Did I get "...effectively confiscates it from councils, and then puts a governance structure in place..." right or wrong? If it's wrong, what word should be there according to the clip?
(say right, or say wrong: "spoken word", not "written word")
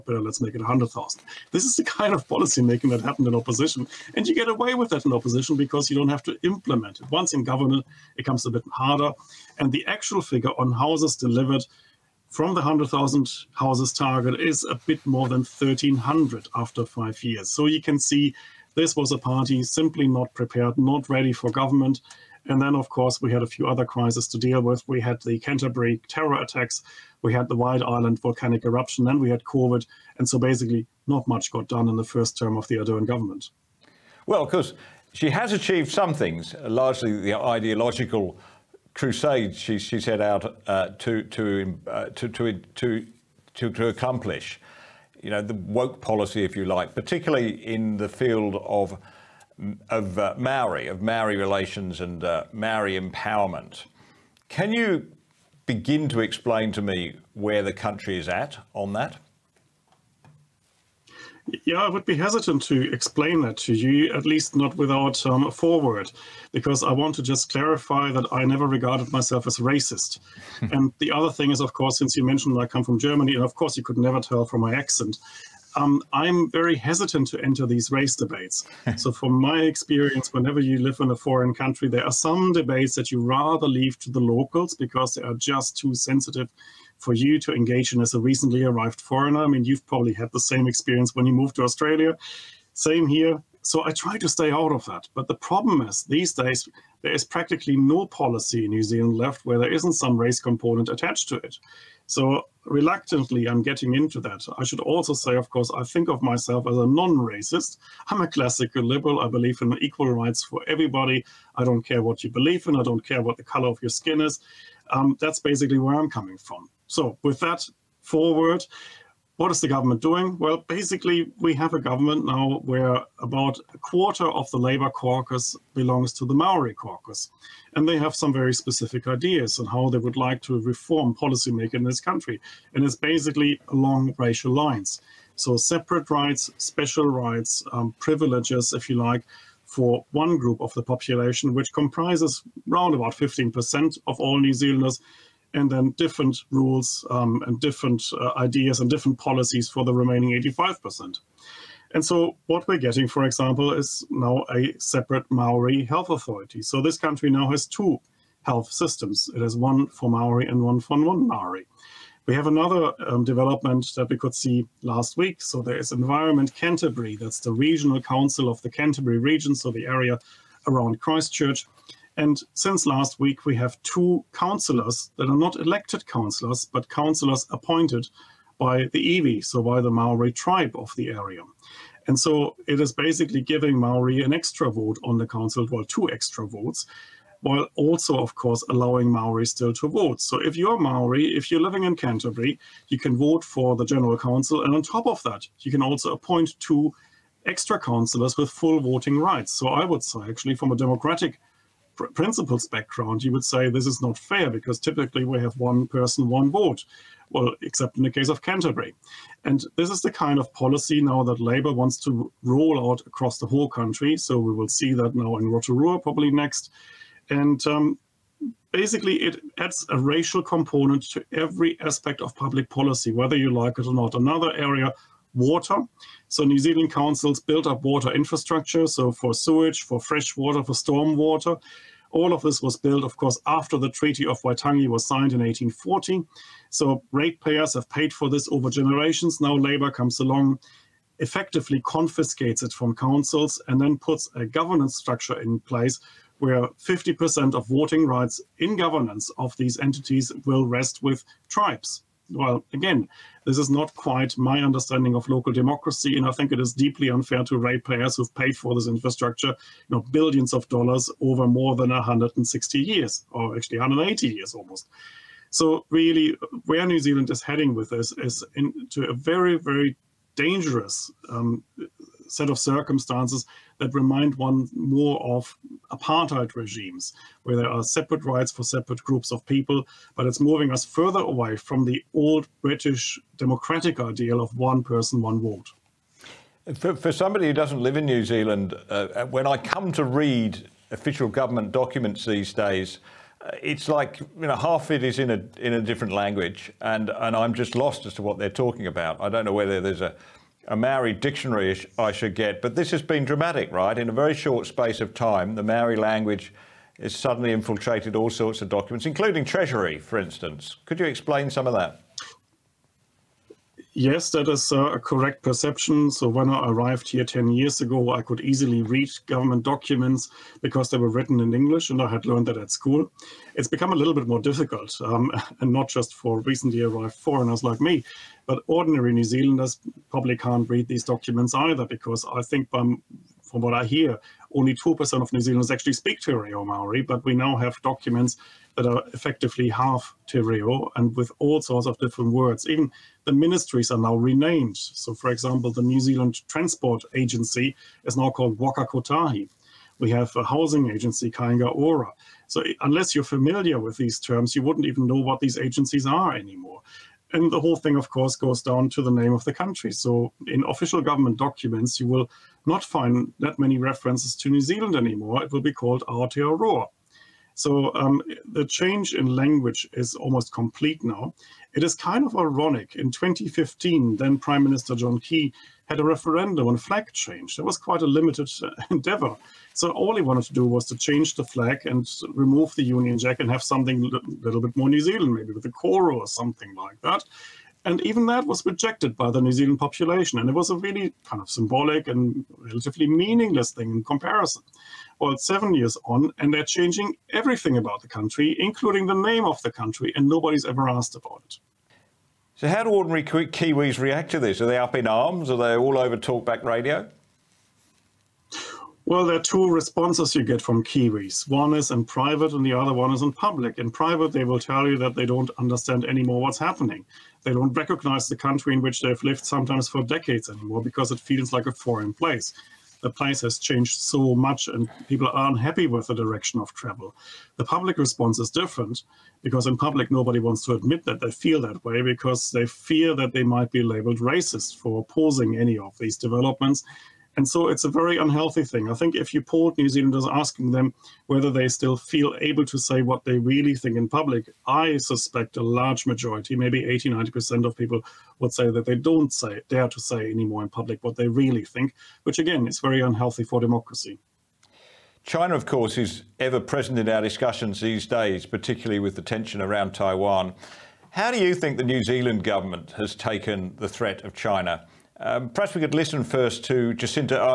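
right.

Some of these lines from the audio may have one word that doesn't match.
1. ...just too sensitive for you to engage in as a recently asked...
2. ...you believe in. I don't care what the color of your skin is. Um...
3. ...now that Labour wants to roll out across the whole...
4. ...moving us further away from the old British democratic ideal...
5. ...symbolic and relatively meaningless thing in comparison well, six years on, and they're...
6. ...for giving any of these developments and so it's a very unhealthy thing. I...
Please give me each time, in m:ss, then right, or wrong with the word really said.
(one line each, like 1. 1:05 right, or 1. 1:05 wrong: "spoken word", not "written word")
1. 1:25 wrong: "arrived", not "asked"
2. 1:52 right
3. 3:31 right
4. 4:40 right
5. 6:31 wrong: "seven", not "six"
6. 7:14 wrong: "opposing", not "giving".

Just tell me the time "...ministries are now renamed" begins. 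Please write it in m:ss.
5:43.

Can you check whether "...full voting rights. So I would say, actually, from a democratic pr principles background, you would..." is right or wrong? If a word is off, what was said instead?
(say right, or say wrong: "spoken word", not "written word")
right.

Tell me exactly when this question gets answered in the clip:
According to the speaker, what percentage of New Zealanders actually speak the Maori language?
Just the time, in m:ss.
5:34.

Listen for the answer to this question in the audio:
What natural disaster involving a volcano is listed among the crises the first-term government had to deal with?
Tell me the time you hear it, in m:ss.
0:27.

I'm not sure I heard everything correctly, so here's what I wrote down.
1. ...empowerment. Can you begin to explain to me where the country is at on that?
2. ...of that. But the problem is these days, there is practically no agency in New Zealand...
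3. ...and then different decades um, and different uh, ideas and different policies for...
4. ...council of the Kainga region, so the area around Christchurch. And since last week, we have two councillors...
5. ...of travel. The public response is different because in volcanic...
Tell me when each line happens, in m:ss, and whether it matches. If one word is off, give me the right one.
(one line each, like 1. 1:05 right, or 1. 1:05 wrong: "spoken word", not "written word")
1. 0:52 right
2. 1:34 wrong: "policy", not "agency"
3. 2:25 wrong: "rules", not "decades"
4. 2:48 wrong: "Canterbury", not "Kainga"
5. 7:06 wrong: "public", not "volcanic".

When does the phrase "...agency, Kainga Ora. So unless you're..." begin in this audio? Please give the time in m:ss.
5:50.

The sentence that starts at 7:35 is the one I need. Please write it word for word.
China, of course, is ever present in our discussions these days, particularly with the tension around Taiwan.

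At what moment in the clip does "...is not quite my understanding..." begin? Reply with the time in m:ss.
4:13.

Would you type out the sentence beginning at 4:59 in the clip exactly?
I don't know whether there's a a Maori dictionary I should get, but this has been dramatic, right?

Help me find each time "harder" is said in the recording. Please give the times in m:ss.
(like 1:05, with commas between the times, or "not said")
0:08.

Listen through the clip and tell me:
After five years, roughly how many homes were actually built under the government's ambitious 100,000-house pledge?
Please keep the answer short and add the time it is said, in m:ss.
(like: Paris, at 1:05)
1,300, at 0:15.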